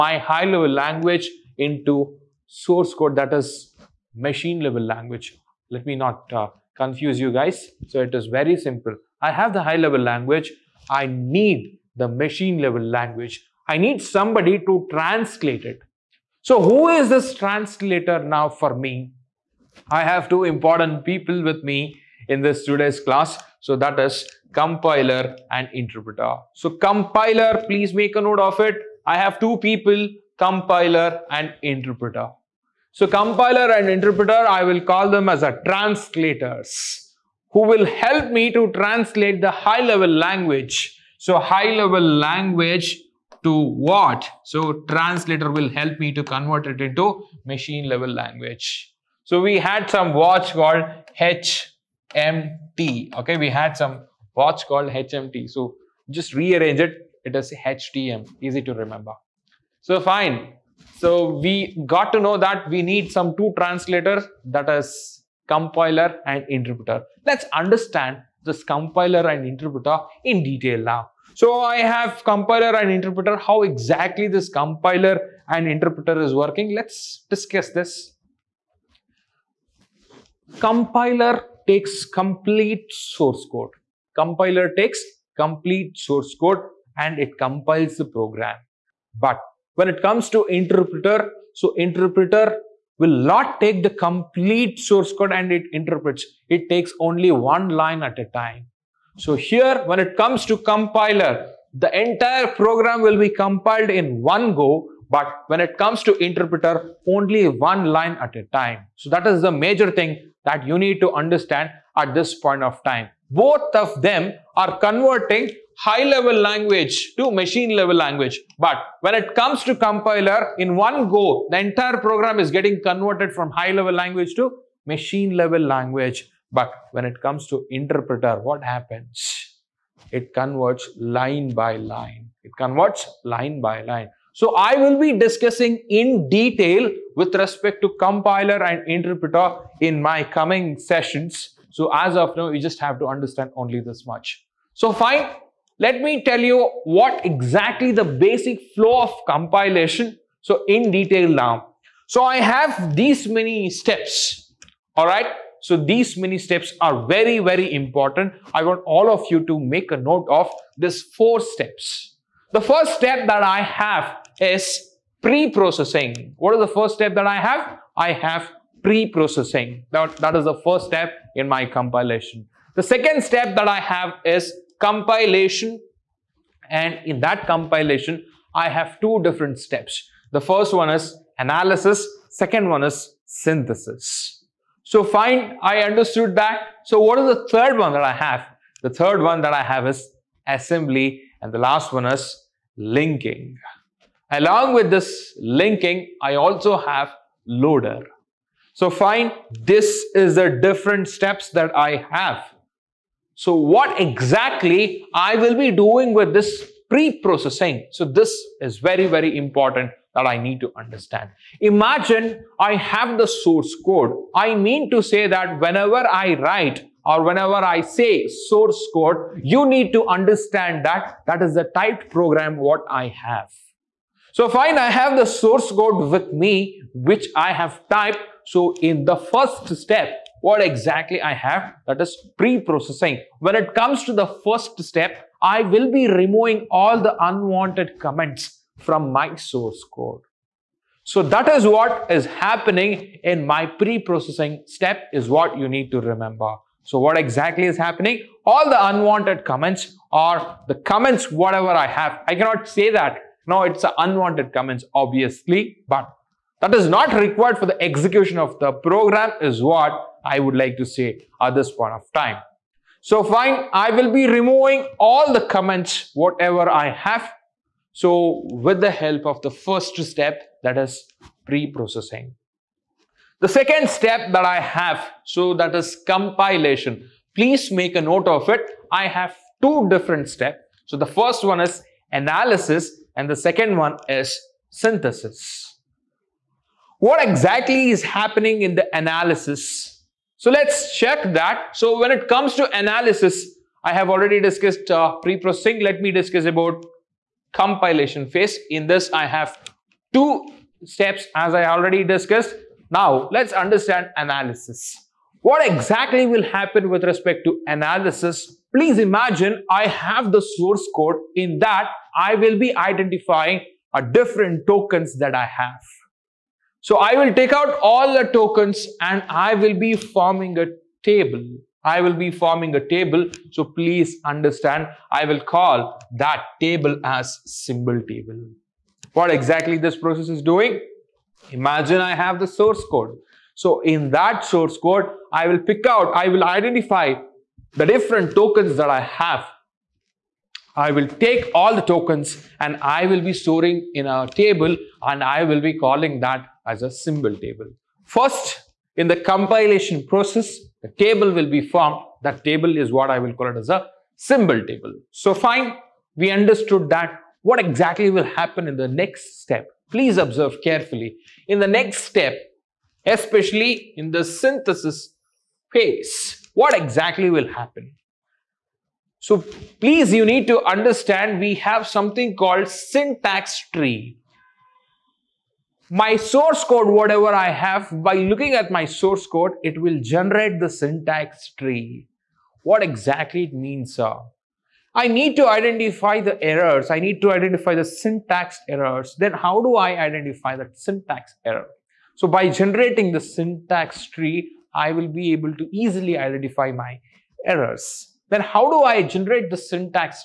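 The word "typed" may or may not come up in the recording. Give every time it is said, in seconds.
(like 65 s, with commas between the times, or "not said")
221 s, 227 s.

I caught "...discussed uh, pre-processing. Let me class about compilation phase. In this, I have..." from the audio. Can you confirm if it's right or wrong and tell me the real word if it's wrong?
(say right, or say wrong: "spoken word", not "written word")
wrong: "discuss", not "class".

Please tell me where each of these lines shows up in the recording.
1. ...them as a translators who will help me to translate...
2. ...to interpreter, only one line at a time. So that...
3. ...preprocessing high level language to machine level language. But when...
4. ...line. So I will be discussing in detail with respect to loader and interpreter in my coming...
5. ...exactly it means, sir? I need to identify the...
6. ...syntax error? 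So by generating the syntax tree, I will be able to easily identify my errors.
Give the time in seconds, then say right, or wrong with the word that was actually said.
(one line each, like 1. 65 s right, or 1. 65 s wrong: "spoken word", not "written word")
1. 35 s right
2. 106 s right
3. 114 s wrong: "converting", not "preprocessing"
4. 133 s wrong: "compiler", not "loader"
5. 382 s right
6. 390 s right.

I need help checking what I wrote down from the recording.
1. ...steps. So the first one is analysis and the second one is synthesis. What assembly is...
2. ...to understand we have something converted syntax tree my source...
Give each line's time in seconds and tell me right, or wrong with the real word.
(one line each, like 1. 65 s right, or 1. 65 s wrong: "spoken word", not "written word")
1. 280 s wrong: "exactly", not "assembly"
2. 370 s wrong: "called", not "converted".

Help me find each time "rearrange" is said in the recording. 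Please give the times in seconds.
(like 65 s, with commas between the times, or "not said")
56 s.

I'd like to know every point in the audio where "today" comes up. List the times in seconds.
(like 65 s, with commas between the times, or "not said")
22 s.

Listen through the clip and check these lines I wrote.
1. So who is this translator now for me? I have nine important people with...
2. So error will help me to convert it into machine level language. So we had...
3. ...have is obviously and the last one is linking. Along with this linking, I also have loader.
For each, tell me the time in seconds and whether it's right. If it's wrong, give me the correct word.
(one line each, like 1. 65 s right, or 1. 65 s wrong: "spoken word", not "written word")
1. 16 s wrong: "two", not "nine"
2. 44 s wrong: "translator", not "error"
3. 189 s wrong: "assembly", not "obviously".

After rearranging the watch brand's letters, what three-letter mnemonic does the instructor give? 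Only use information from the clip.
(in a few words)
HTM.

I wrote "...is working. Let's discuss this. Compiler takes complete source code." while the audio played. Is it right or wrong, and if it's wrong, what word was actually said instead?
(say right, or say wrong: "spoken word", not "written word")
right.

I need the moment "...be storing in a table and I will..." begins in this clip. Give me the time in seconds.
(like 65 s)
343 s.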